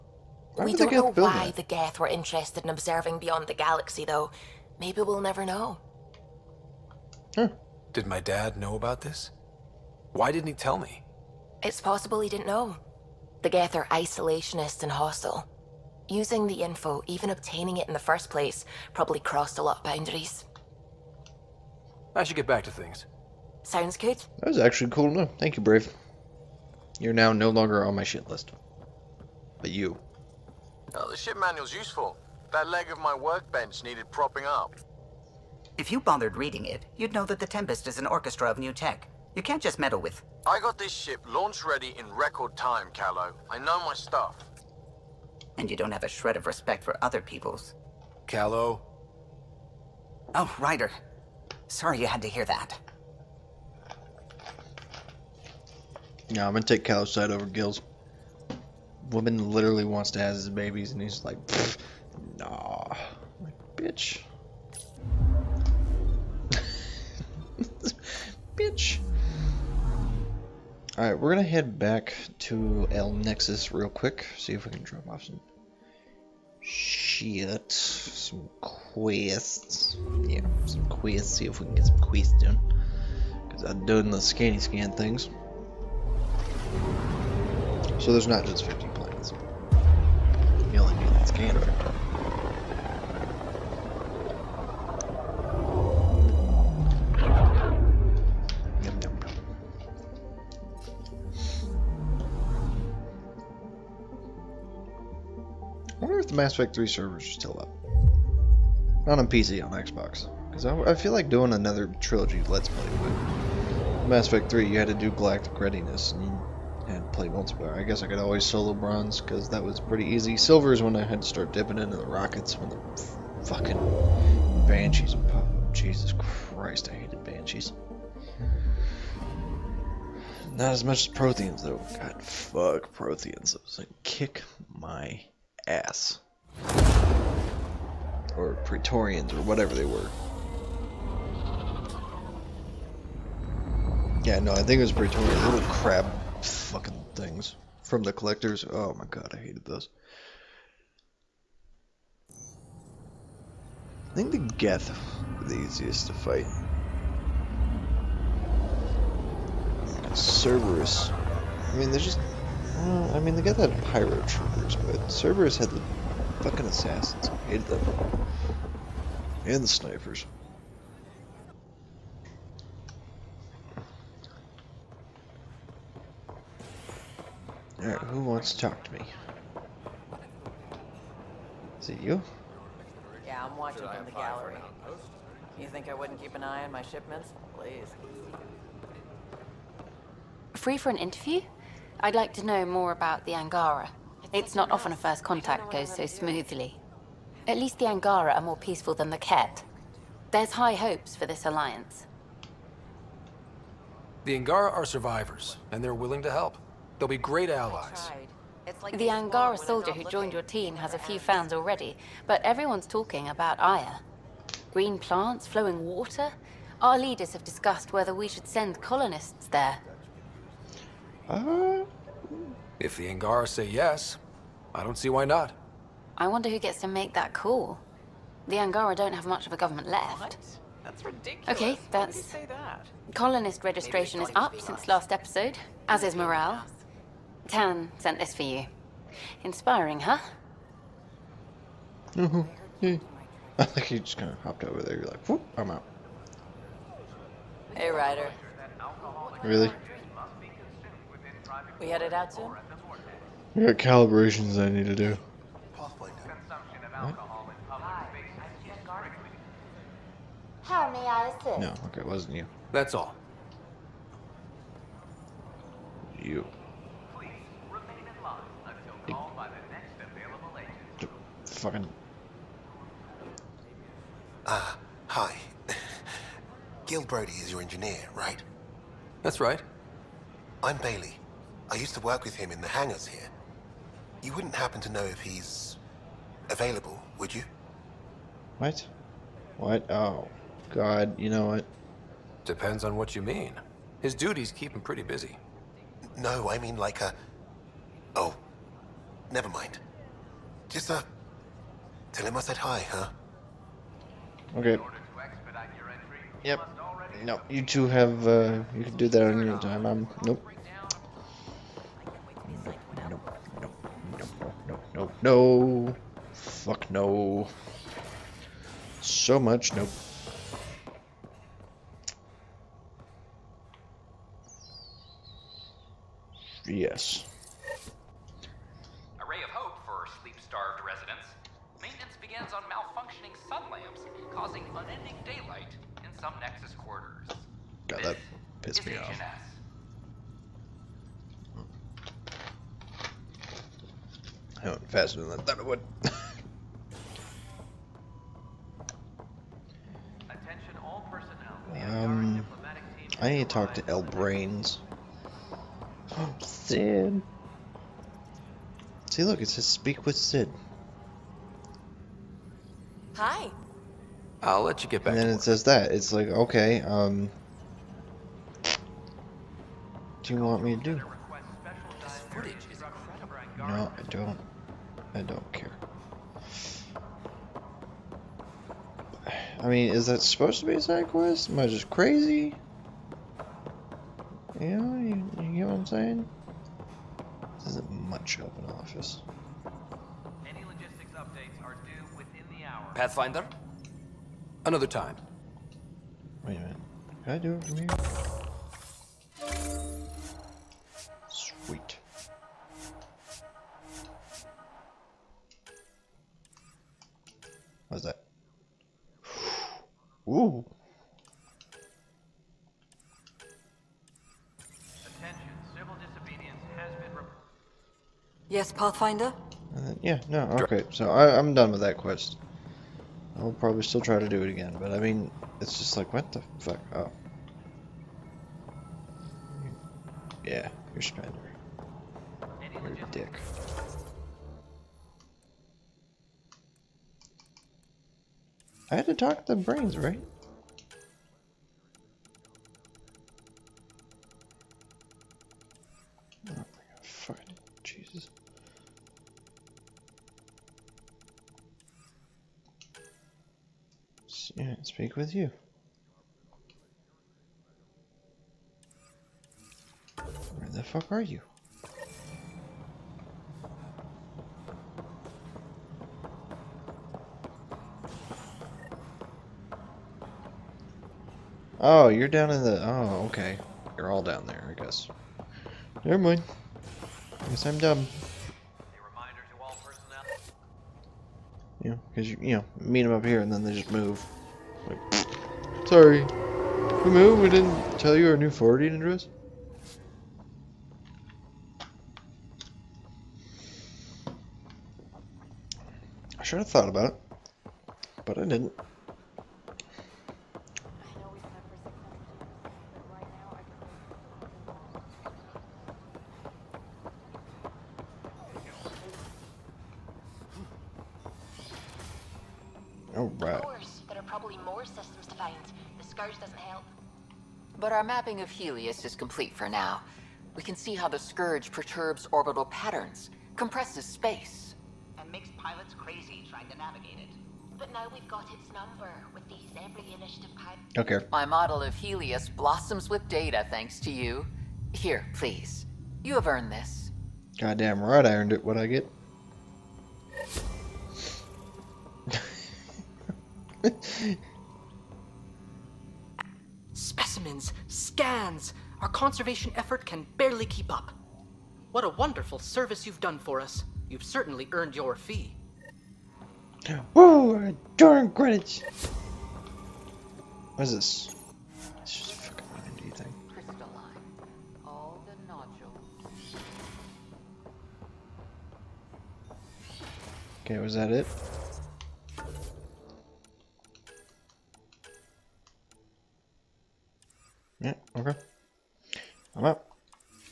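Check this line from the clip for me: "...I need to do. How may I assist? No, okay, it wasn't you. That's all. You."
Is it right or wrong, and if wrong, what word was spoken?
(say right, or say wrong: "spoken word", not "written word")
right.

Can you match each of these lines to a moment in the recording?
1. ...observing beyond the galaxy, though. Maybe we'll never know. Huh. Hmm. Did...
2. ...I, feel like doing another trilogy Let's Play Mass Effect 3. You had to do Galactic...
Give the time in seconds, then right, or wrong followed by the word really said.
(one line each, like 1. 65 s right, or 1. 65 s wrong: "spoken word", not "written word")
1. 2 s right
2. 110 s right.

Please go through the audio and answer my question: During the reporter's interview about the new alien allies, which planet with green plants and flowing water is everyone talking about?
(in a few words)
Aya.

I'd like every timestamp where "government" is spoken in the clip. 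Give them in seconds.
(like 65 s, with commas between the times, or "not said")
229 s.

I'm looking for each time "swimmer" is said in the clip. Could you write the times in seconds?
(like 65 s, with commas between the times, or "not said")
not said.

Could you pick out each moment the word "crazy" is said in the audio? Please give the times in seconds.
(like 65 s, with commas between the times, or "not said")
381 s, 525 s.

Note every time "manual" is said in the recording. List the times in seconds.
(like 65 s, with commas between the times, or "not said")
31 s.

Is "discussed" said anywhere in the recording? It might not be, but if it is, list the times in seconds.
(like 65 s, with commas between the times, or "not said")
217 s.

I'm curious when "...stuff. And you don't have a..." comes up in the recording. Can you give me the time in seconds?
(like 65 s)
43 s.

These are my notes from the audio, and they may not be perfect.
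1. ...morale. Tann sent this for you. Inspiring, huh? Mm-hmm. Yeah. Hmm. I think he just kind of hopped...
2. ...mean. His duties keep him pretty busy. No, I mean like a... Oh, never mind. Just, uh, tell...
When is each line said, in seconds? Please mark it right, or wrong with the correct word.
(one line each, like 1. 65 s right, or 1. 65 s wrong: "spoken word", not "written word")
1. 236 s right
2. 293 s right.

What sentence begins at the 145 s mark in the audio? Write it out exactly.
Little crab fucking things from the collectors.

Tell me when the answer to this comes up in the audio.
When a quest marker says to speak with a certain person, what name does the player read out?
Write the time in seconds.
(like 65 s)
360 s.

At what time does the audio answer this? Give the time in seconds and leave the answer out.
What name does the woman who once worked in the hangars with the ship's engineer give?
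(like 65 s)
280 s.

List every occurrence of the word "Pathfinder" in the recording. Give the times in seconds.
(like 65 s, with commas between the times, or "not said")
392 s, 418 s.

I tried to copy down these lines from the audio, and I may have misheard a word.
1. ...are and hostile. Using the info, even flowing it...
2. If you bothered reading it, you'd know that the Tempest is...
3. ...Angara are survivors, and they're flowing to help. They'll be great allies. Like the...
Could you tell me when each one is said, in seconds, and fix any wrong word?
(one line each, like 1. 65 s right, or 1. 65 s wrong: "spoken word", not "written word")
1. 13 s wrong: "obtaining", not "flowing"
2. 35 s right
3. 204 s wrong: "willing", not "flowing".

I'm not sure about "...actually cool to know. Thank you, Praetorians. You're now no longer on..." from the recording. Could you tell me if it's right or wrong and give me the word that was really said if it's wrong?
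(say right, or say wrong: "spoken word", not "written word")
wrong: "Brave", not "Praetorians".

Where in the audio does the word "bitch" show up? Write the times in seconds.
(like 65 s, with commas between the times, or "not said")
63 s, 68 s.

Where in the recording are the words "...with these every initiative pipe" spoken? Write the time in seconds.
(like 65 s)
529 s.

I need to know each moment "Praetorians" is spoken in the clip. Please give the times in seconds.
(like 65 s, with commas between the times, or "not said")
138 s, 144 s.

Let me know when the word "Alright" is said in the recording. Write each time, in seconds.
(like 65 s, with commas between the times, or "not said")
70 s, 177 s.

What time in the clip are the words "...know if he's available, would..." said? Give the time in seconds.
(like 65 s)
284 s.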